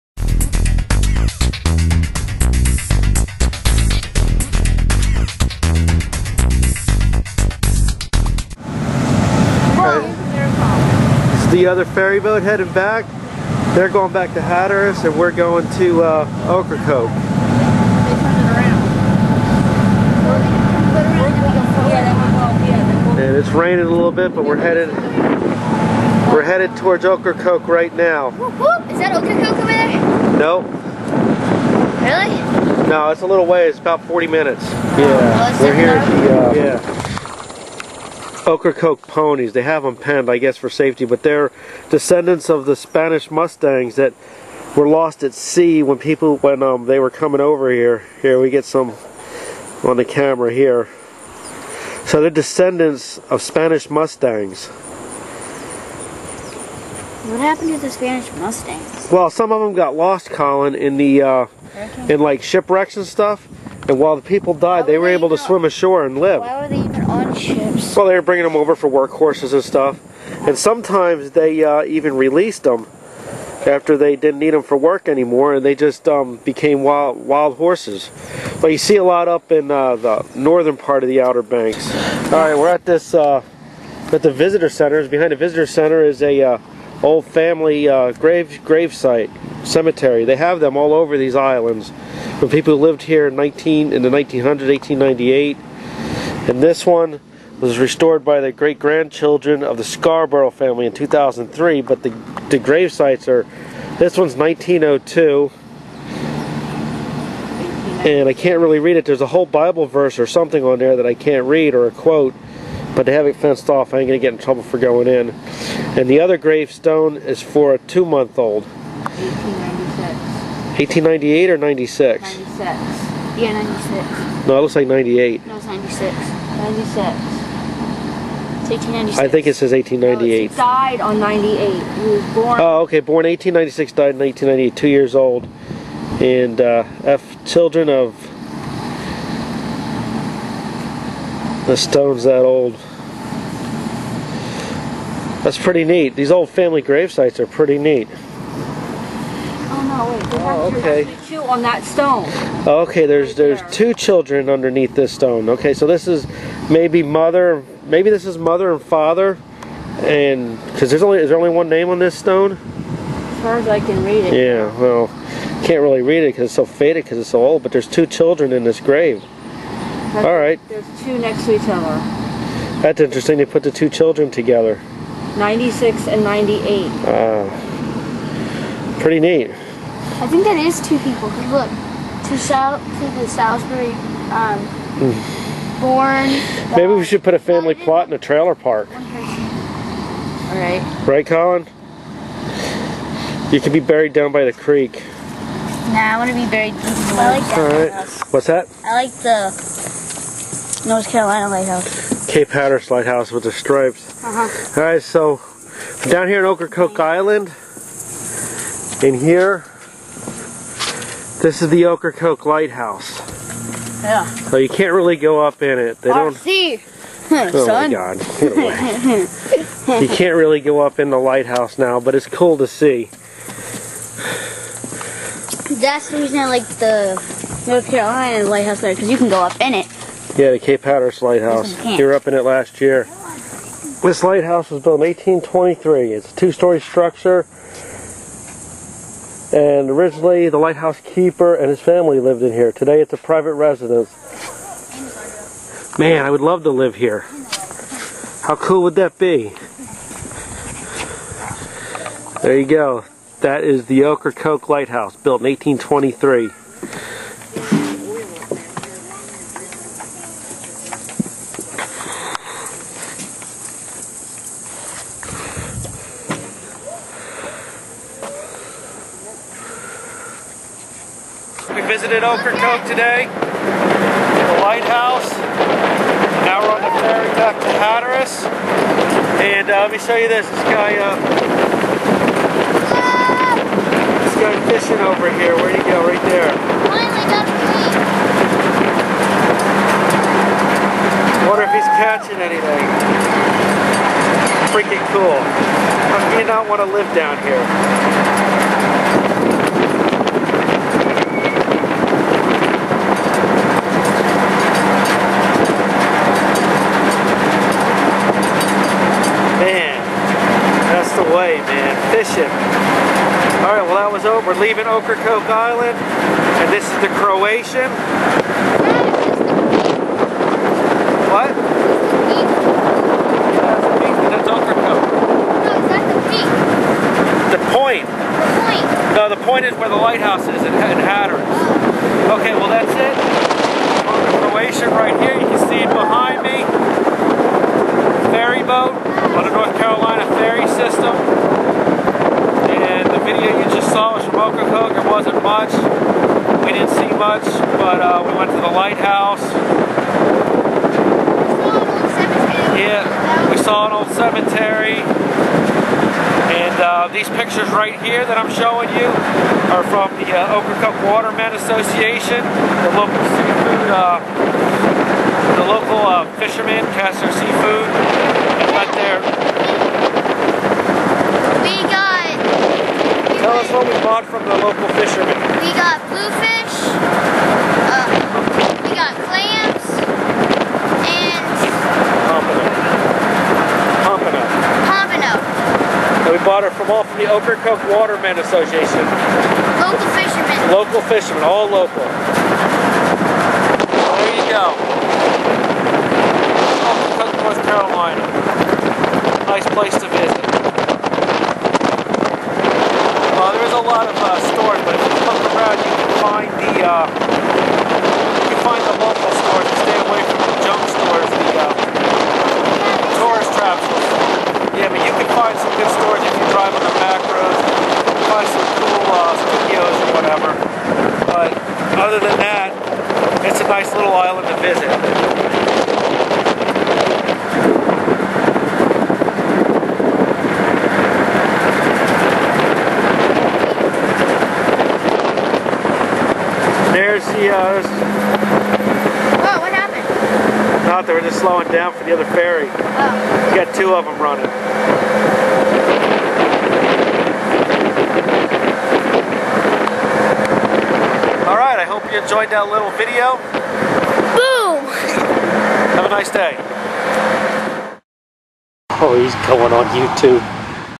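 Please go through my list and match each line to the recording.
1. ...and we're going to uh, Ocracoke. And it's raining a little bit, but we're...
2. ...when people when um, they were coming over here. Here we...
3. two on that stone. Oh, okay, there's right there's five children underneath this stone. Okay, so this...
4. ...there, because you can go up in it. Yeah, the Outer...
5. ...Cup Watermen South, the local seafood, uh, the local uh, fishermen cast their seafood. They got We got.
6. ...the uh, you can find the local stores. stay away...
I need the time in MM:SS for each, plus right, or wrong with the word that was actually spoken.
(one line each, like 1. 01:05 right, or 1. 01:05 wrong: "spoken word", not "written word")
1. 00:15 right
2. 00:45 right
3. 02:31 wrong: "two", not "five"
4. 03:48 wrong: "Cape", not "Outer"
5. 06:00 wrong: "Association", not "South"
6. 06:46 right.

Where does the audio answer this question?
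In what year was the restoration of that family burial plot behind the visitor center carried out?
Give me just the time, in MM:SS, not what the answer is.
01:40.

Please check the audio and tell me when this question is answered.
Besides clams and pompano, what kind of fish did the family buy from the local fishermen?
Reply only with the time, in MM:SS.
06:16.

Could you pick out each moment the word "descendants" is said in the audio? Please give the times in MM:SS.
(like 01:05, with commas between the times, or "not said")
00:41, 00:52.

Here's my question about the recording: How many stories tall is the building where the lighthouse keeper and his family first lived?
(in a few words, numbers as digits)
2.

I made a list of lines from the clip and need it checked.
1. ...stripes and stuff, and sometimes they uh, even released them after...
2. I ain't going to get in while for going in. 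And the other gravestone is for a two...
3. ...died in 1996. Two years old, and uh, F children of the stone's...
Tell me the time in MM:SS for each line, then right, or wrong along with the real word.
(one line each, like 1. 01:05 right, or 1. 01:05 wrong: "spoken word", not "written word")
1. 01:08 wrong: "workhorses", not "stripes"
2. 01:53 wrong: "trouble", not "while"
3. 02:13 wrong: "1998", not "1996".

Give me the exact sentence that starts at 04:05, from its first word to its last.
Man, I would love to live here.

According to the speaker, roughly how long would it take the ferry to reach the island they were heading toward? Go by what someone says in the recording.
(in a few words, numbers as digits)
40 minutes.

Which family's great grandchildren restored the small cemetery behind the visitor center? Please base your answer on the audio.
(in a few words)
Scarborough.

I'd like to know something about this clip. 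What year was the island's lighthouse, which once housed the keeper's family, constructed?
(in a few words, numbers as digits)
1823.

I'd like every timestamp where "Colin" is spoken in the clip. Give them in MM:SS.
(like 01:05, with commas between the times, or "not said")
01:00, 03:11.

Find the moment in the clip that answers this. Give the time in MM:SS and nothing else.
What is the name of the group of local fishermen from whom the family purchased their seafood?
06:27.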